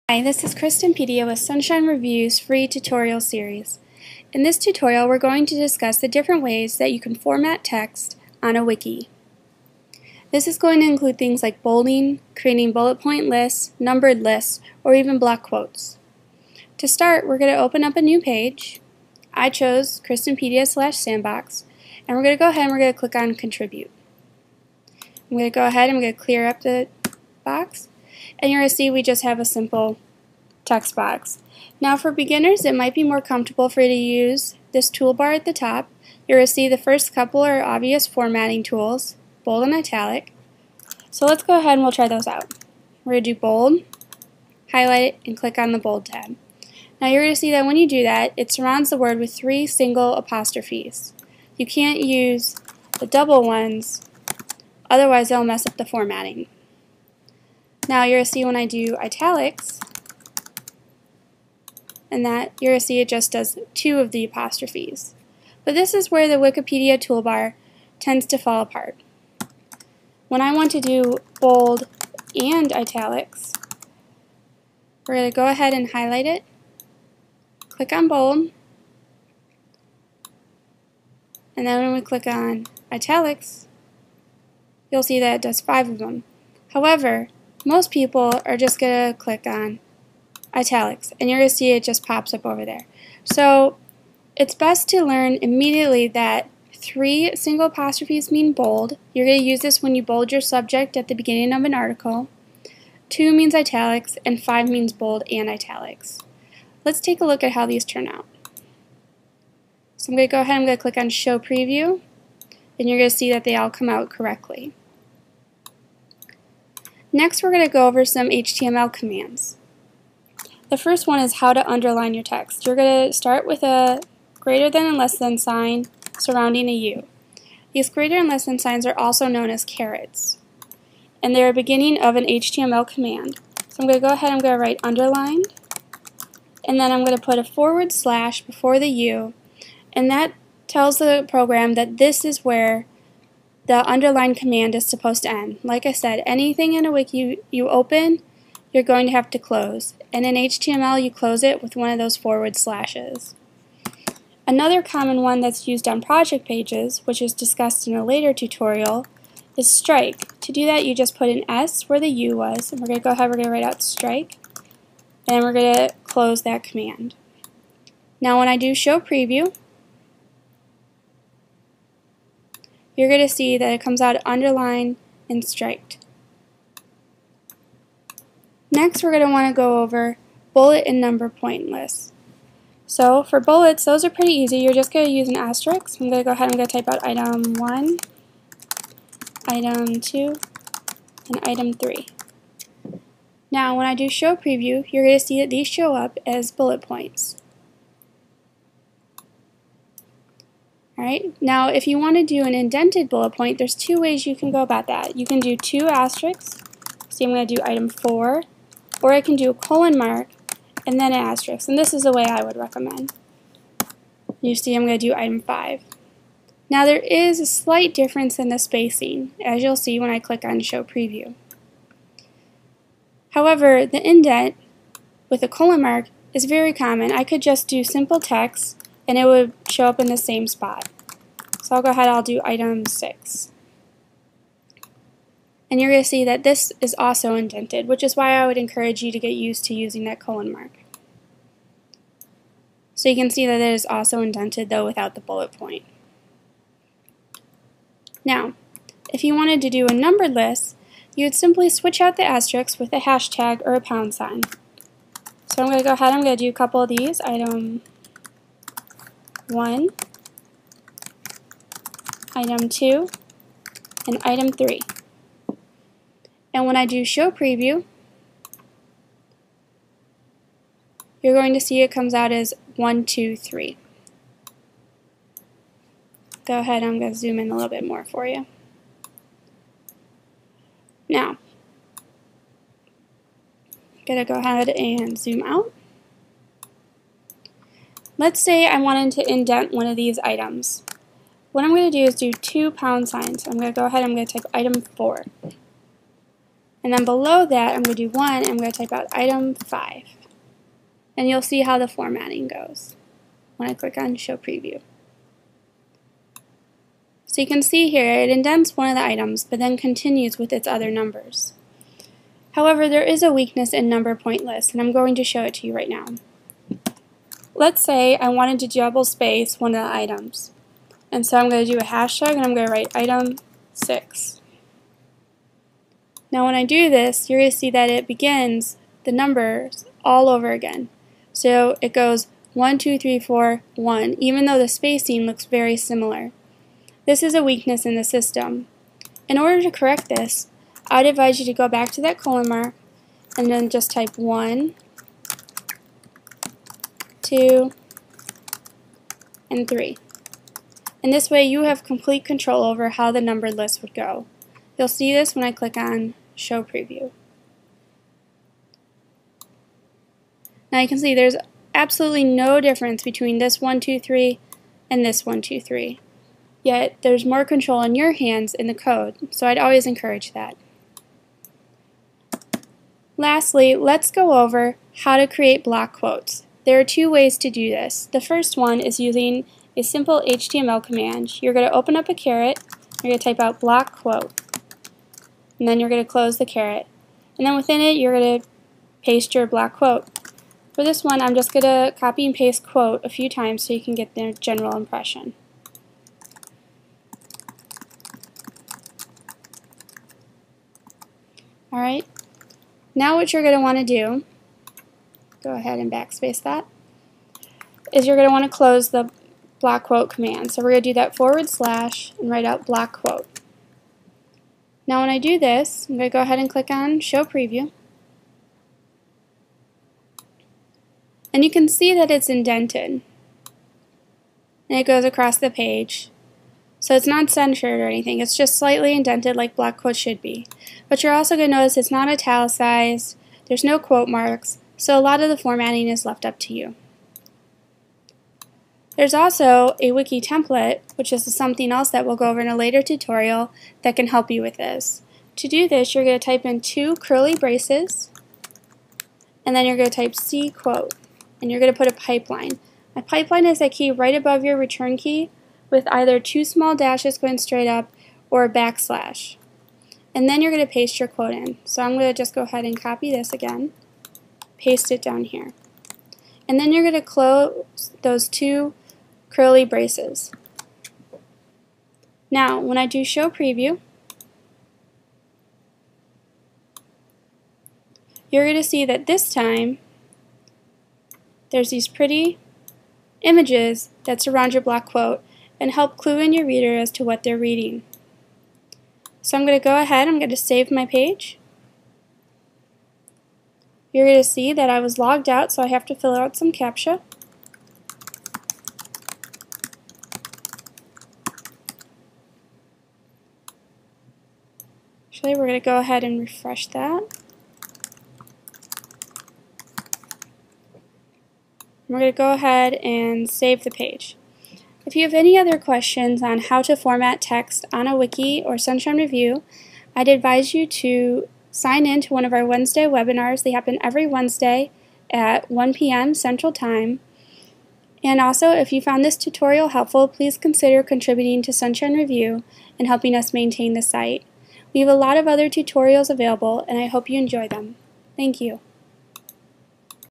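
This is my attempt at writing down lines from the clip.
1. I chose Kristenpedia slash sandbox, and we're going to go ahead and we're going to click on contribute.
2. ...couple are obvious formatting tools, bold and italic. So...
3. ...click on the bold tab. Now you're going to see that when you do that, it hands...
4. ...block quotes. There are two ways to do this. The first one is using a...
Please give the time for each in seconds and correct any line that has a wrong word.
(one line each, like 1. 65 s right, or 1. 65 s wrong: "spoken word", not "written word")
1. 19 s right
2. 37 s right
3. 45 s wrong: "surrounds", not "hands"
4. 375 s right.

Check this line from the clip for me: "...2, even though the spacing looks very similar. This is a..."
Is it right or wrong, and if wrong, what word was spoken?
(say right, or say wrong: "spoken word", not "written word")
wrong: "1", not "2".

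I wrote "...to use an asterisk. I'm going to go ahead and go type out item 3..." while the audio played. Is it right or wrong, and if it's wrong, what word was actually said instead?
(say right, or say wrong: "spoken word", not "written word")
wrong: "1", not "3".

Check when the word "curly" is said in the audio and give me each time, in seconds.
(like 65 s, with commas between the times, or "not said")
446 s, 469 s.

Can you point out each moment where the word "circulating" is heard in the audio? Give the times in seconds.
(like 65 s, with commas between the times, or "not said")
not said.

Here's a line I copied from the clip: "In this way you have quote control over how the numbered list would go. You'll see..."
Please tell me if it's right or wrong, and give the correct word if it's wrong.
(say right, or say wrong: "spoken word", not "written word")
wrong: "complete", not "quote".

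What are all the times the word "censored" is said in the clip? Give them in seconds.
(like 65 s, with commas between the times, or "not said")
427 s.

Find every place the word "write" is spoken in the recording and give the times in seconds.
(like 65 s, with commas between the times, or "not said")
134 s, 163 s, 322 s, 412 s.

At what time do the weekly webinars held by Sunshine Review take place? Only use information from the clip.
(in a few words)
1 p.m. Central Time.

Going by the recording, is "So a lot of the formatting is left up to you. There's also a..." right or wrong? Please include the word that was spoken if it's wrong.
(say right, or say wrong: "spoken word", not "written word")
right.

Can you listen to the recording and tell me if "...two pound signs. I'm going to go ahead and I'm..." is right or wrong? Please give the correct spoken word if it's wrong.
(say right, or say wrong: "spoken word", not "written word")
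right.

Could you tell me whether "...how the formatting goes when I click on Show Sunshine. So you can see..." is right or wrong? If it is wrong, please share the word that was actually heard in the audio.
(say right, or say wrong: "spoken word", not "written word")
wrong: "Preview", not "Sunshine".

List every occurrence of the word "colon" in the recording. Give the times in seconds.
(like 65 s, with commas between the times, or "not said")
209 s, 225 s, 240 s, 342 s.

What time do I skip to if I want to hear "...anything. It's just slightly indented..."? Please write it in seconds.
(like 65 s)
427 s.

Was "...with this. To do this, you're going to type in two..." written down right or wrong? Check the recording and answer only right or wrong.
right.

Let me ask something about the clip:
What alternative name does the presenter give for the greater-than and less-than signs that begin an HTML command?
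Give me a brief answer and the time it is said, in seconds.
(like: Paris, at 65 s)
carets, at 129 s.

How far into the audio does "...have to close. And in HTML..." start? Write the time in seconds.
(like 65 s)
149 s.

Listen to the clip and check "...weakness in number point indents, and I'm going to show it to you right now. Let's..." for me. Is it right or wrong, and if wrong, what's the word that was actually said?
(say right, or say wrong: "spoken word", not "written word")
wrong: "lists", not "indents".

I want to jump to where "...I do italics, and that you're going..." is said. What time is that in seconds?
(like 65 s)
58 s.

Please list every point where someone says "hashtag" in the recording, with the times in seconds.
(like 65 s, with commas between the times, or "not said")
252 s, 321 s.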